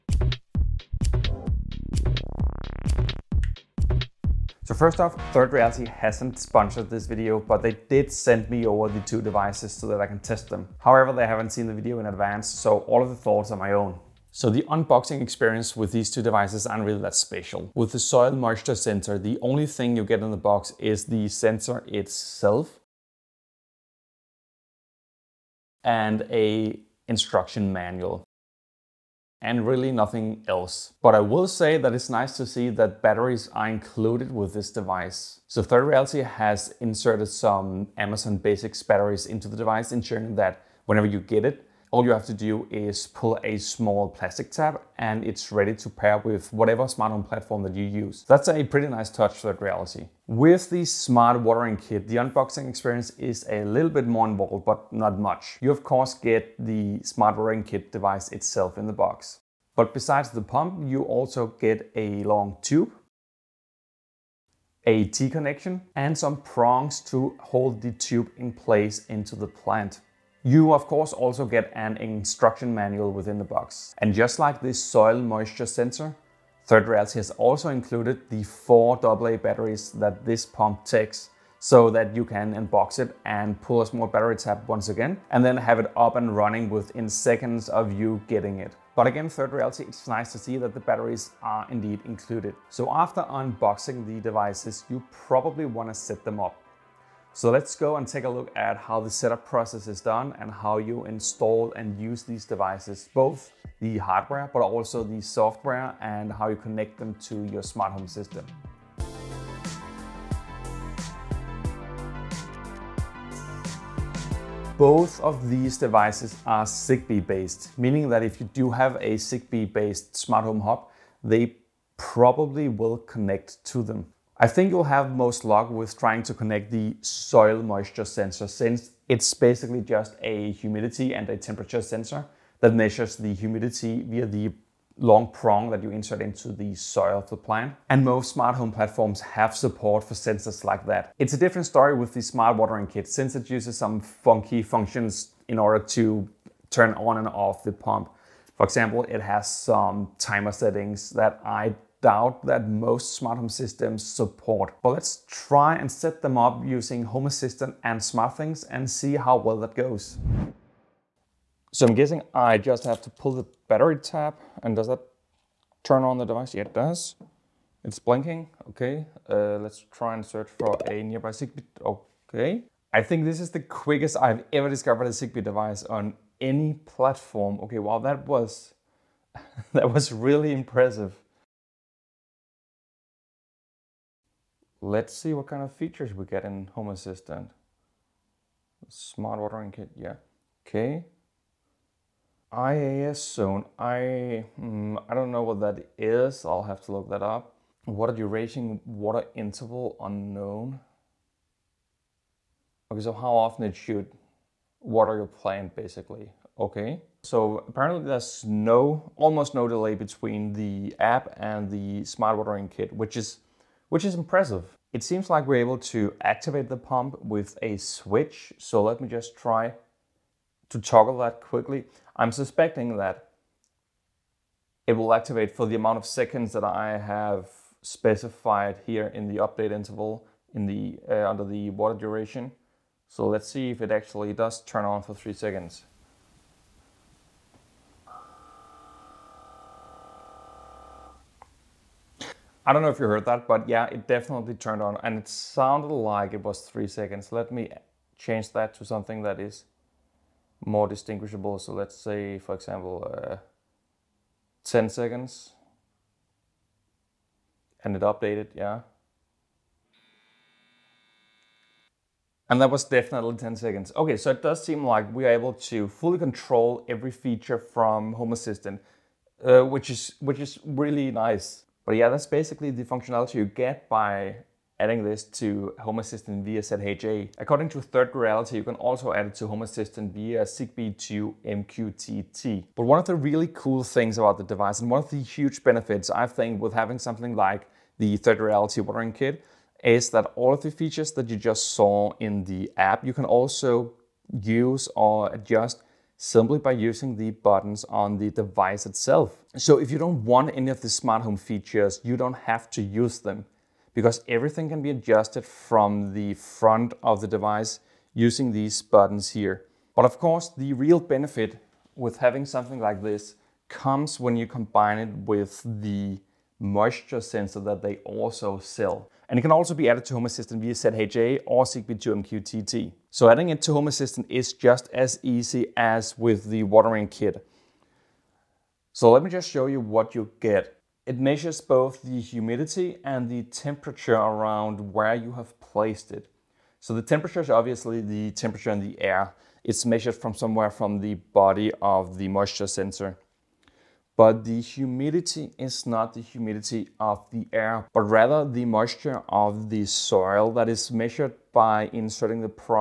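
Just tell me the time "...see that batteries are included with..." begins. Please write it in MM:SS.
00:32.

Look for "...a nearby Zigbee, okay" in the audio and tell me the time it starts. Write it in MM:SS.
02:50.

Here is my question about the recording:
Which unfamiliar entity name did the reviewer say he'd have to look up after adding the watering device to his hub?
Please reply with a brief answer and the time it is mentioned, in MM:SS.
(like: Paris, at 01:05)
IAS zone, at 03:12.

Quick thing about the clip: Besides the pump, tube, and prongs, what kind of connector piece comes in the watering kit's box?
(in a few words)
T connection.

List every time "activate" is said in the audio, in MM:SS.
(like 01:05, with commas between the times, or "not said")
03:36, 03:45.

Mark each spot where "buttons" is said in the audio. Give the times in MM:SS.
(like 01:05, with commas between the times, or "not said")
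04:57, 05:08.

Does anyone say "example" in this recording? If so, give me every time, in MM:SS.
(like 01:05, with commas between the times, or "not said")
02:28, 04:12.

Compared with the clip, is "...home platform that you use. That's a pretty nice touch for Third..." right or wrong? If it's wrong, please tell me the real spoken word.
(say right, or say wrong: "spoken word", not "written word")
right.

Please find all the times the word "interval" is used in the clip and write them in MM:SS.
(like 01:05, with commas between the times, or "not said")
03:19, 03:49.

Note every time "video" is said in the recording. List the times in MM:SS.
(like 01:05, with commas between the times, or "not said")
00:07, 00:11.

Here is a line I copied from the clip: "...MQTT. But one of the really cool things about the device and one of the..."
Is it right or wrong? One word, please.
right.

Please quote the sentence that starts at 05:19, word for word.
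And it can also be added to Home Assistant via ZHA or Zigbee 2 MQTT.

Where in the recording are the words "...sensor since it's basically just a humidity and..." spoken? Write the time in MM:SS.
02:08.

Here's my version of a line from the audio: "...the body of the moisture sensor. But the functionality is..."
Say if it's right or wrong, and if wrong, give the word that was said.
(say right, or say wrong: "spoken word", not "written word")
wrong: "humidity", not "functionality".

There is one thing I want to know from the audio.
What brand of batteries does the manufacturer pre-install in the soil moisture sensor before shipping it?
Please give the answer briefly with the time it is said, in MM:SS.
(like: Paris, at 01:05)
Amazon Basics, at 00:37.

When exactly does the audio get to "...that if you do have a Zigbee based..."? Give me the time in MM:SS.
01:58.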